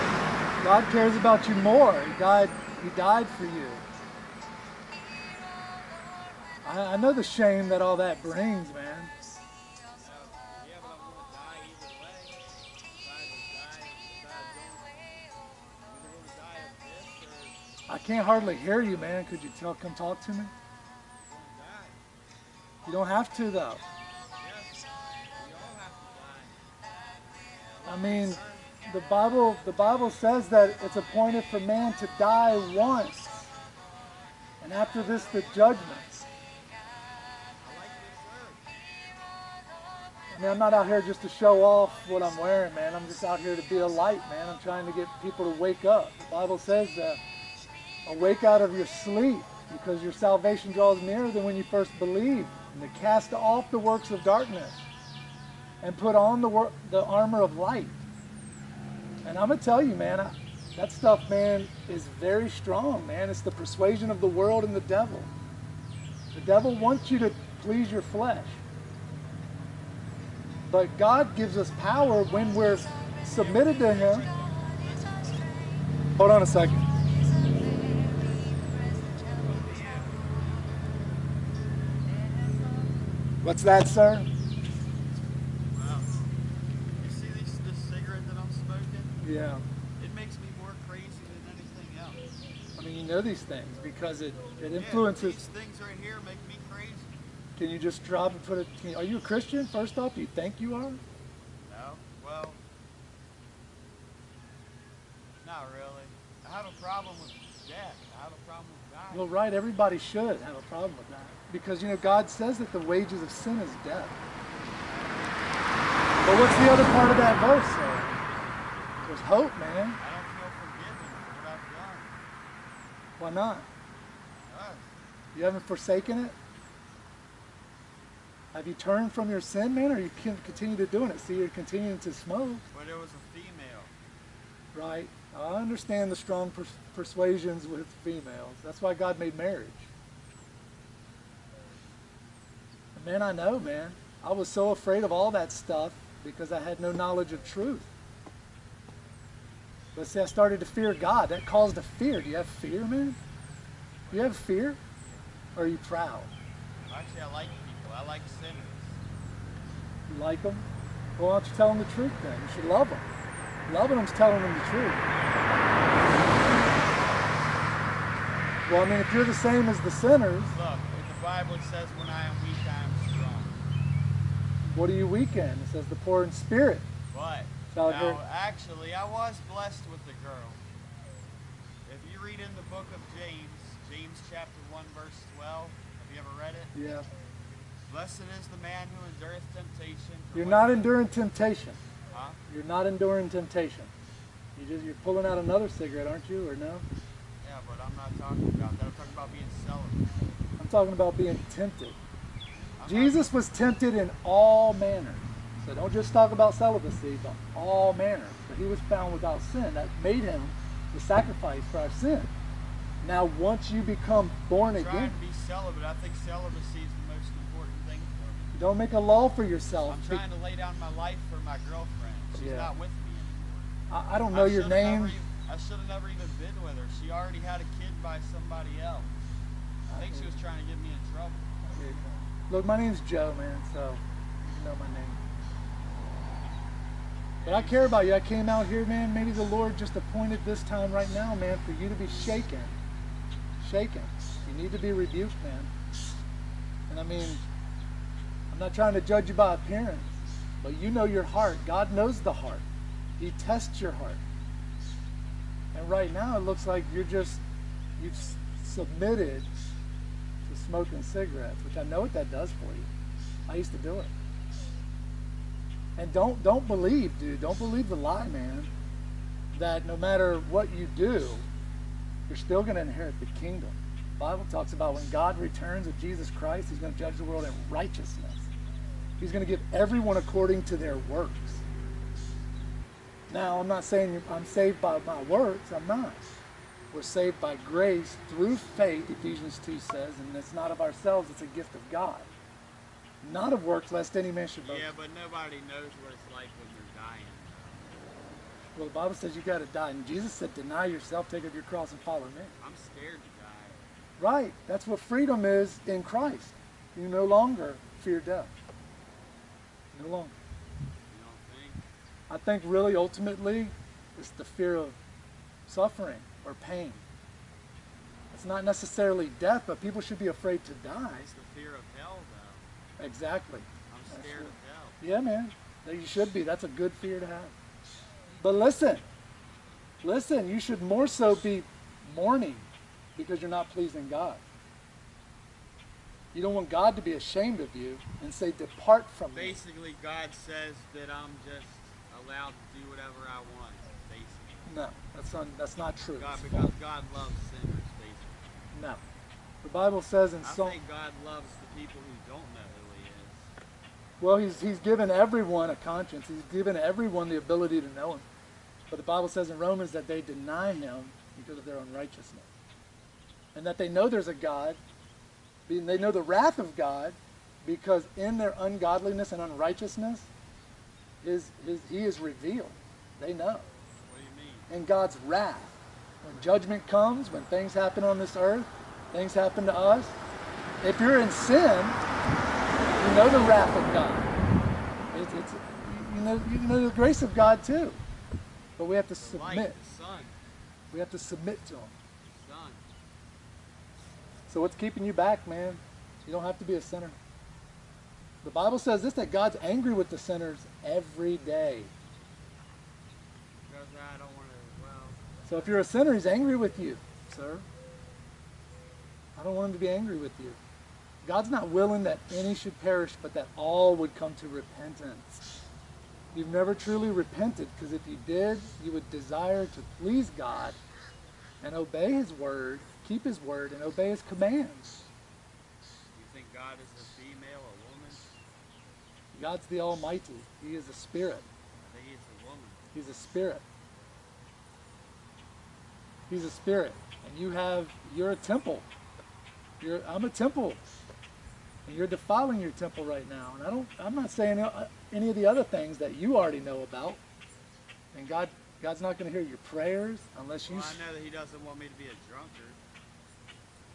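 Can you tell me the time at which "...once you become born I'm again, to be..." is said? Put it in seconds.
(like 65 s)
213 s.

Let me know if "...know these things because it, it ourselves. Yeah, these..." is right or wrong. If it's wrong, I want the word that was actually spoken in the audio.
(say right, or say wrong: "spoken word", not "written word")
wrong: "influences", not "ourselves".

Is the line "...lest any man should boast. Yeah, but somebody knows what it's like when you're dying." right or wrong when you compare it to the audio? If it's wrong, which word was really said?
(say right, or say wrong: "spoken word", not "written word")
wrong: "nobody", not "somebody".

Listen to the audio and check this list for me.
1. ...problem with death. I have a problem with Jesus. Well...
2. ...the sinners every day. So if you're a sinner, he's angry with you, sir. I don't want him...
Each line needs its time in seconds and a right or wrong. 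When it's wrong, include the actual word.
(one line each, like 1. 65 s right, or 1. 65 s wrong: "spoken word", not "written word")
1. 106 s wrong: "God", not "Jesus"
2. 400 s right.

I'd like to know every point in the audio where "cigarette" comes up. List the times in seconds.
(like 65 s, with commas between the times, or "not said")
87 s, 195 s, 261 s.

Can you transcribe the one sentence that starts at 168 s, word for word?
Well, I mean, if you're the same as the sinners.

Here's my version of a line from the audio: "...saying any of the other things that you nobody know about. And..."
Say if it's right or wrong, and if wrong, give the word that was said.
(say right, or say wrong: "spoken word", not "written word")
wrong: "already", not "nobody".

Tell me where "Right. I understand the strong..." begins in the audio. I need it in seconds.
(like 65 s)
134 s.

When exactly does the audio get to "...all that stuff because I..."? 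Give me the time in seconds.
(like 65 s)
145 s.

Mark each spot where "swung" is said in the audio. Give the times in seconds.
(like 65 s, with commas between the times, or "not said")
not said.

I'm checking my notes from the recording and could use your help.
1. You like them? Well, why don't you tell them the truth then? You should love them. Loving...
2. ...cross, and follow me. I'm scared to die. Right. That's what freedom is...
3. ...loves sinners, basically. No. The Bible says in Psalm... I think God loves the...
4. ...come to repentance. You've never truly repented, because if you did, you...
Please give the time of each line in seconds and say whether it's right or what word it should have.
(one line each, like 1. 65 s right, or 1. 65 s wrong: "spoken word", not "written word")
1. 160 s right
2. 301 s right
3. 347 s right
4. 414 s right.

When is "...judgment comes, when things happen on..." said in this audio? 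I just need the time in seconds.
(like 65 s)
376 s.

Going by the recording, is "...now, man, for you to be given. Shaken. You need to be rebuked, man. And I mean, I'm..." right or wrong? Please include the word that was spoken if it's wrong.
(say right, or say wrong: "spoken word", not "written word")
wrong: "shaken", not "given".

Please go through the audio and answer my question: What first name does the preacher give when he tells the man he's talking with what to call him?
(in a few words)
Joe.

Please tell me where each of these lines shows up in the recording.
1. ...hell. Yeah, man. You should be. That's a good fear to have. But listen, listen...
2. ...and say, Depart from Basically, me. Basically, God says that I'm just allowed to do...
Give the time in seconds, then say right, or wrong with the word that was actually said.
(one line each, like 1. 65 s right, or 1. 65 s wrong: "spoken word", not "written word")
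1. 324 s right
2. 338 s right.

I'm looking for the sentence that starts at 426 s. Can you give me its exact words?
You think God is a female, a woman?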